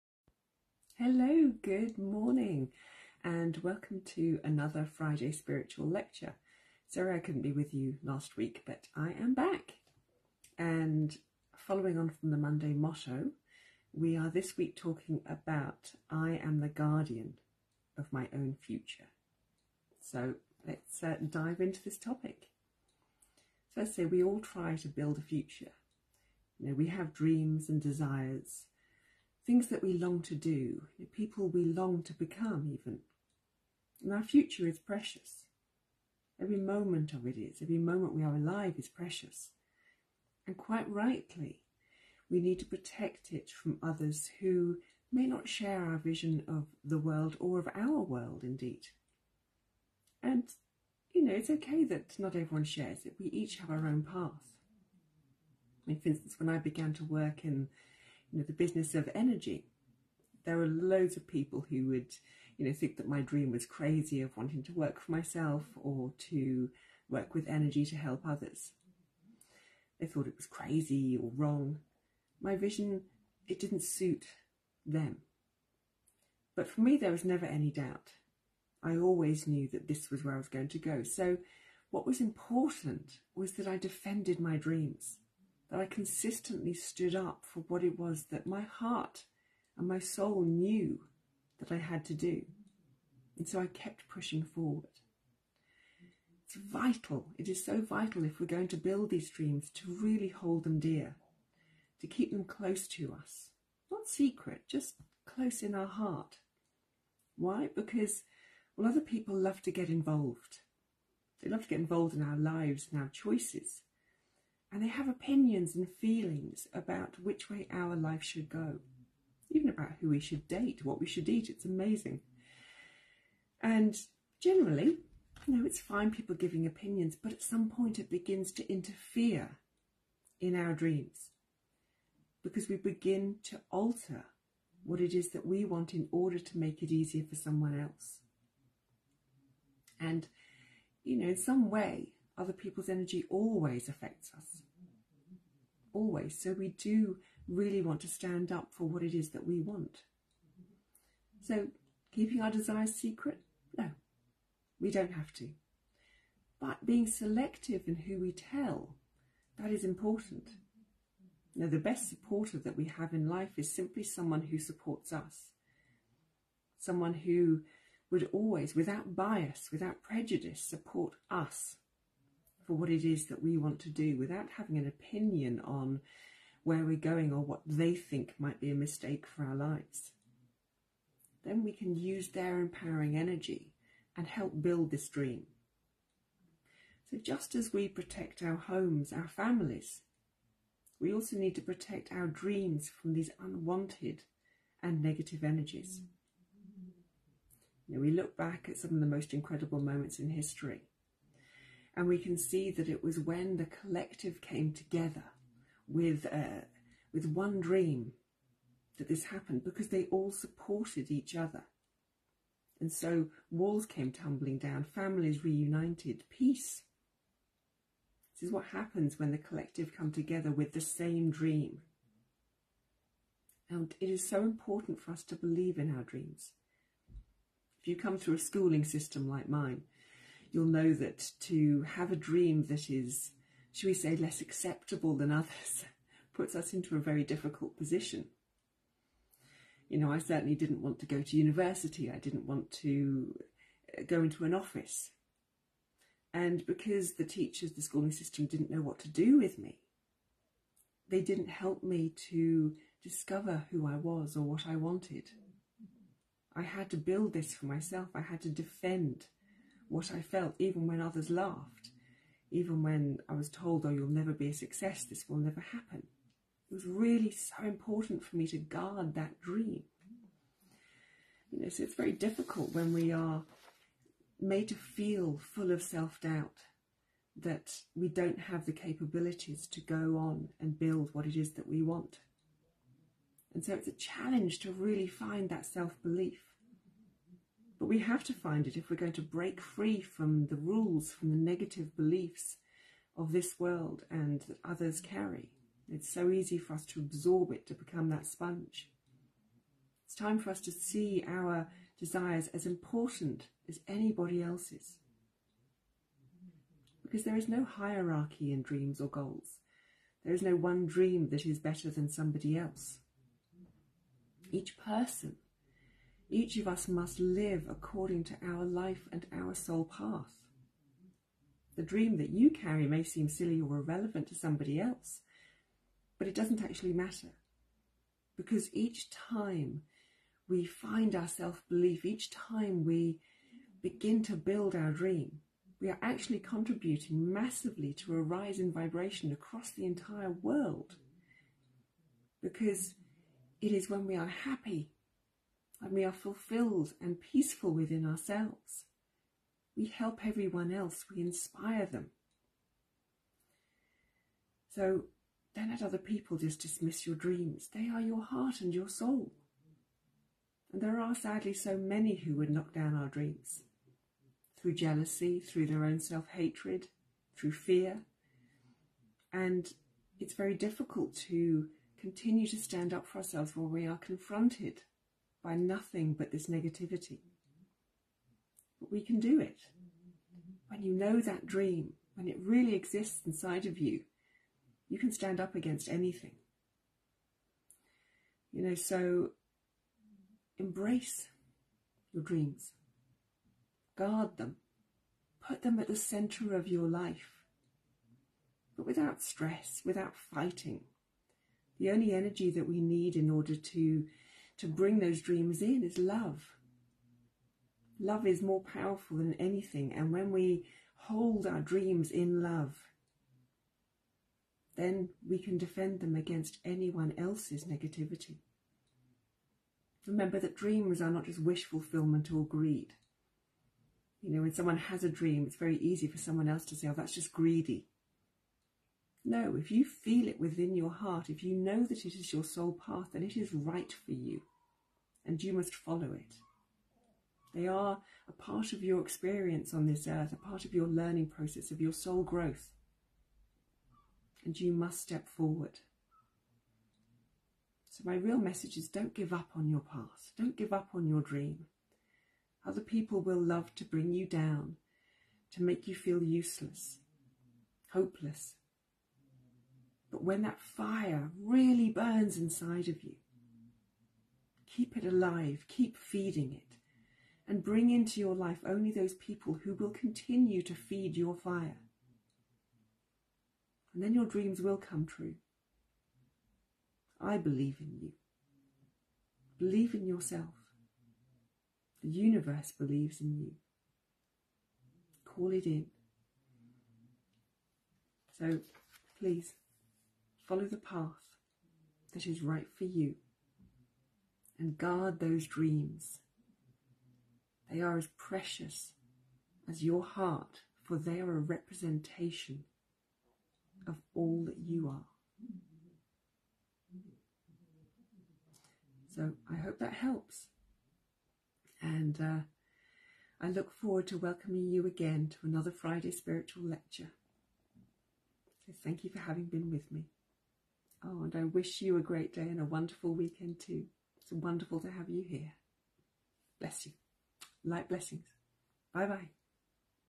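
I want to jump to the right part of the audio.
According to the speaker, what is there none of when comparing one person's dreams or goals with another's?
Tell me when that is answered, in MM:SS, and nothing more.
05:07.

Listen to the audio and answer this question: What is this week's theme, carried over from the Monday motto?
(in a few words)
I am the guardian of my own future.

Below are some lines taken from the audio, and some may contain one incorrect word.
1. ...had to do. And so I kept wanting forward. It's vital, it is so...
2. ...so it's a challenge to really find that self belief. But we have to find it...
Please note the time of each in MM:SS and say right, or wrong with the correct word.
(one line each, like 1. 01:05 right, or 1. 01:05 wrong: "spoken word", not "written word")
1. 01:31 wrong: "pushing", not "wanting"
2. 04:43 right.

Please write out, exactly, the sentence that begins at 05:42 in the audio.
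Because it is when we are happy and we are fulfilled and peaceful within ourselves.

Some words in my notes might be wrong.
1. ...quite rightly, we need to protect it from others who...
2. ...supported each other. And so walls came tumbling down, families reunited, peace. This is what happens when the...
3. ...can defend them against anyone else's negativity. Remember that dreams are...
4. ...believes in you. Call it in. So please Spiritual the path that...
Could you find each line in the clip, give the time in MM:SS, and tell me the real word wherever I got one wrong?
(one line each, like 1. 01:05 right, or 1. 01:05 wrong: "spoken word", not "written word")
1. 00:40 right
2. 03:30 right
3. 06:55 right
4. 08:02 wrong: "Follow", not "Spiritual".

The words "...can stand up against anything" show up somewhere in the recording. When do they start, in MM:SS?
06:24.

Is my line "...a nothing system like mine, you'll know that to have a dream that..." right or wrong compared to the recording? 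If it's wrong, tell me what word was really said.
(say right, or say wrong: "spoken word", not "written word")
wrong: "schooling", not "nothing".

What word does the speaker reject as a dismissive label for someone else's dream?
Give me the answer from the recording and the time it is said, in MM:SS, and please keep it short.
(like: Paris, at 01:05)
greedy, at 07:07.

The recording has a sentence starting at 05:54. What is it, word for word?
So don't let other people just dismiss your dreams.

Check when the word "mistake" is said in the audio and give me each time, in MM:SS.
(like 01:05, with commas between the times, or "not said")
02:58.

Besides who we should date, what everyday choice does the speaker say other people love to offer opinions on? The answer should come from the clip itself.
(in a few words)
what we should eat.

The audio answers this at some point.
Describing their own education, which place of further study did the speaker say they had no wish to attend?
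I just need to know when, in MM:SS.
04:01.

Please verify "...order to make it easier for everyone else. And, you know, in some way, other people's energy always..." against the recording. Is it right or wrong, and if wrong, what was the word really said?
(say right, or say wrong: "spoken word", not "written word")
wrong: "someone", not "everyone".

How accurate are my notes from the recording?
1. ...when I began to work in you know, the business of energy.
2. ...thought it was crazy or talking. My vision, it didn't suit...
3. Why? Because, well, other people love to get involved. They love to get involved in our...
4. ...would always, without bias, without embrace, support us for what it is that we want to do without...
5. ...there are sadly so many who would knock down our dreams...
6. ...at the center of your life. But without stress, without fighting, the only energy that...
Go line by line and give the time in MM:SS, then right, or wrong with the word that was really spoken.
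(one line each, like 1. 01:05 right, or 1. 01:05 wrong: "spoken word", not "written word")
1. 00:56 right
2. 01:10 wrong: "wrong", not "talking"
3. 01:47 right
4. 02:48 wrong: "prejudice", not "embrace"
5. 06:00 right
6. 06:35 right.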